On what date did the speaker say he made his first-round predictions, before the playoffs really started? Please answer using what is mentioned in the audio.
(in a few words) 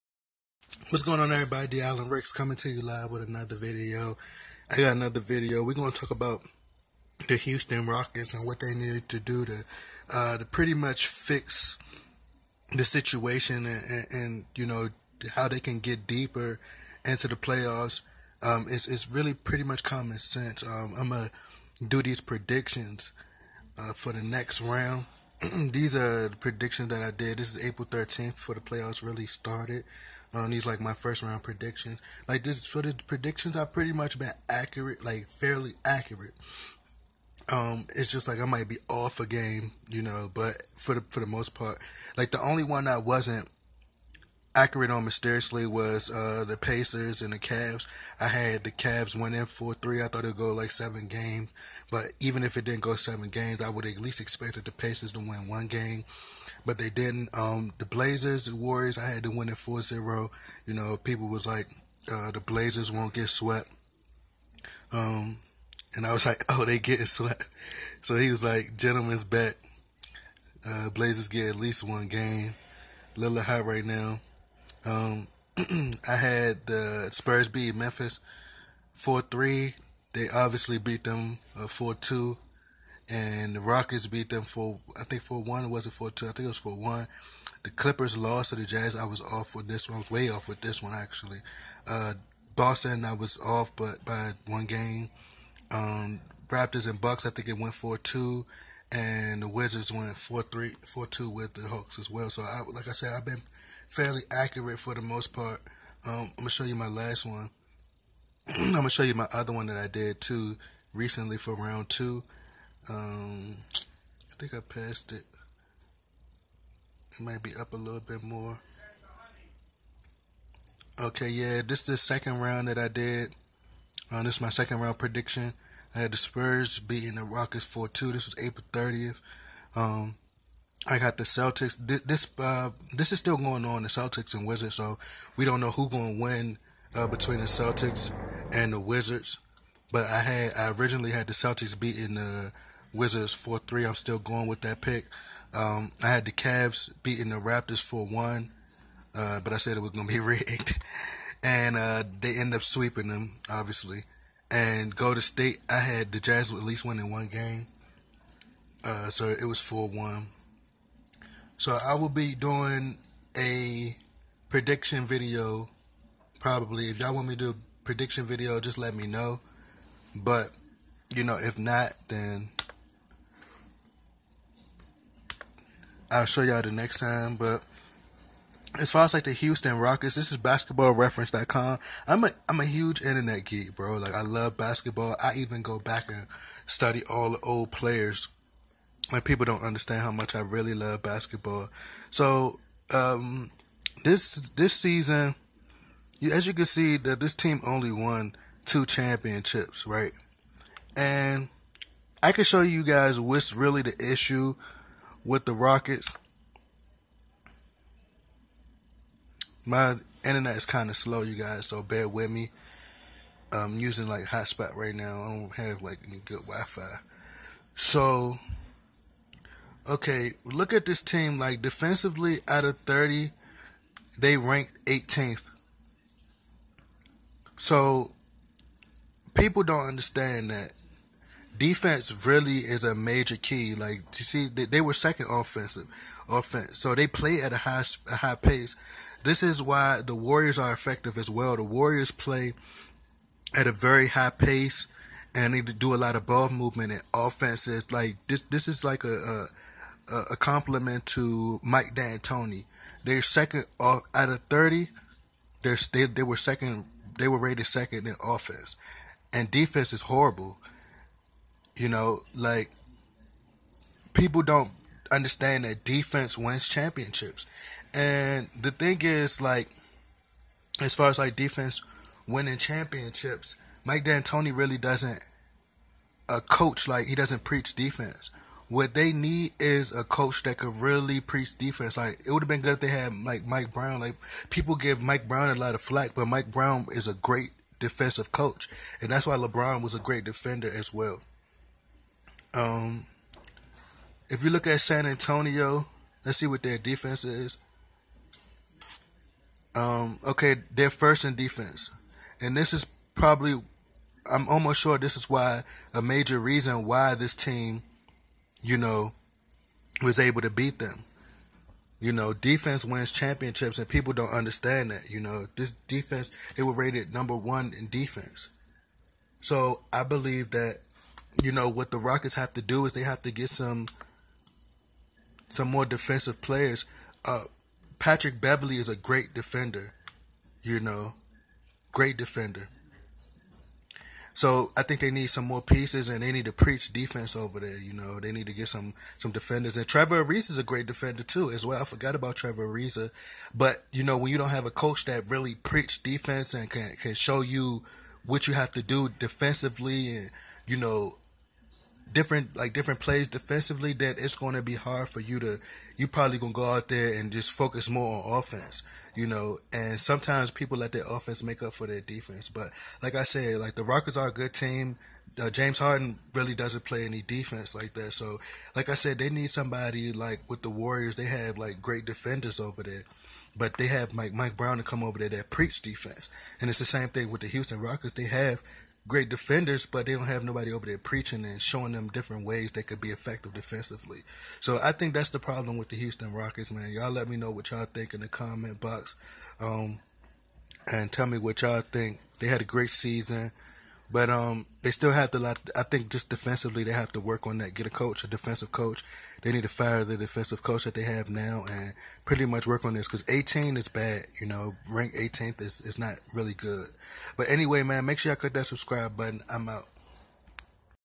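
April 13th.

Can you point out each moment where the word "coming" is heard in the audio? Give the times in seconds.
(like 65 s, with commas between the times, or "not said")
2 s.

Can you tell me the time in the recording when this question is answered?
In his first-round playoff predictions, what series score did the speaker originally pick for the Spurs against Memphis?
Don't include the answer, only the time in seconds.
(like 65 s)
77 s.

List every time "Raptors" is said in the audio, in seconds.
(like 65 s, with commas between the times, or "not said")
96 s, 147 s.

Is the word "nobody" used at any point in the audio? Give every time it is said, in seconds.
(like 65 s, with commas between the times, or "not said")
380 s.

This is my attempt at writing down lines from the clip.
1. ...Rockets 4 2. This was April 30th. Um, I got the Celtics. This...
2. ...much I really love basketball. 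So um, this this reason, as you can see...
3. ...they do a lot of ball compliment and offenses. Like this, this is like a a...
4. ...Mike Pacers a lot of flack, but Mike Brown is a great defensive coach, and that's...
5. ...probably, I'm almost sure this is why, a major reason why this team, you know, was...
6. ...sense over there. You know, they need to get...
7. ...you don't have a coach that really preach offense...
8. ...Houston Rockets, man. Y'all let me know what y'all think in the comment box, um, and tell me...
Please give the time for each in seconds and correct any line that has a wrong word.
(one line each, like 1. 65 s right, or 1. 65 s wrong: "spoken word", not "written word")
1. 127 s right
2. 190 s wrong: "season", not "reason"
3. 245 s wrong: "movement", not "compliment"
4. 285 s wrong: "Brown", not "Pacers"
5. 303 s right
6. 336 s wrong: "defense", not "sense"
7. 344 s wrong: "defense", not "offense"
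8. 385 s right.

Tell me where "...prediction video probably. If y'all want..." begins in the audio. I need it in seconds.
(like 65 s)
164 s.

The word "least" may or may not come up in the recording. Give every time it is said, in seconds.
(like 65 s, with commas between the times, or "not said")
53 s, 71 s, 156 s.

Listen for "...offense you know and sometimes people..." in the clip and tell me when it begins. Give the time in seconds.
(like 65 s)
358 s.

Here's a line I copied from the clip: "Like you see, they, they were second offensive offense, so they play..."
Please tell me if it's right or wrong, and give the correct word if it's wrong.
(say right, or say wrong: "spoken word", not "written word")
right.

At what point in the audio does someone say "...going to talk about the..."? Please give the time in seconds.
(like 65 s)
5 s.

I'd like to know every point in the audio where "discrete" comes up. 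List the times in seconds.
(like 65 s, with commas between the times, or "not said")
not said.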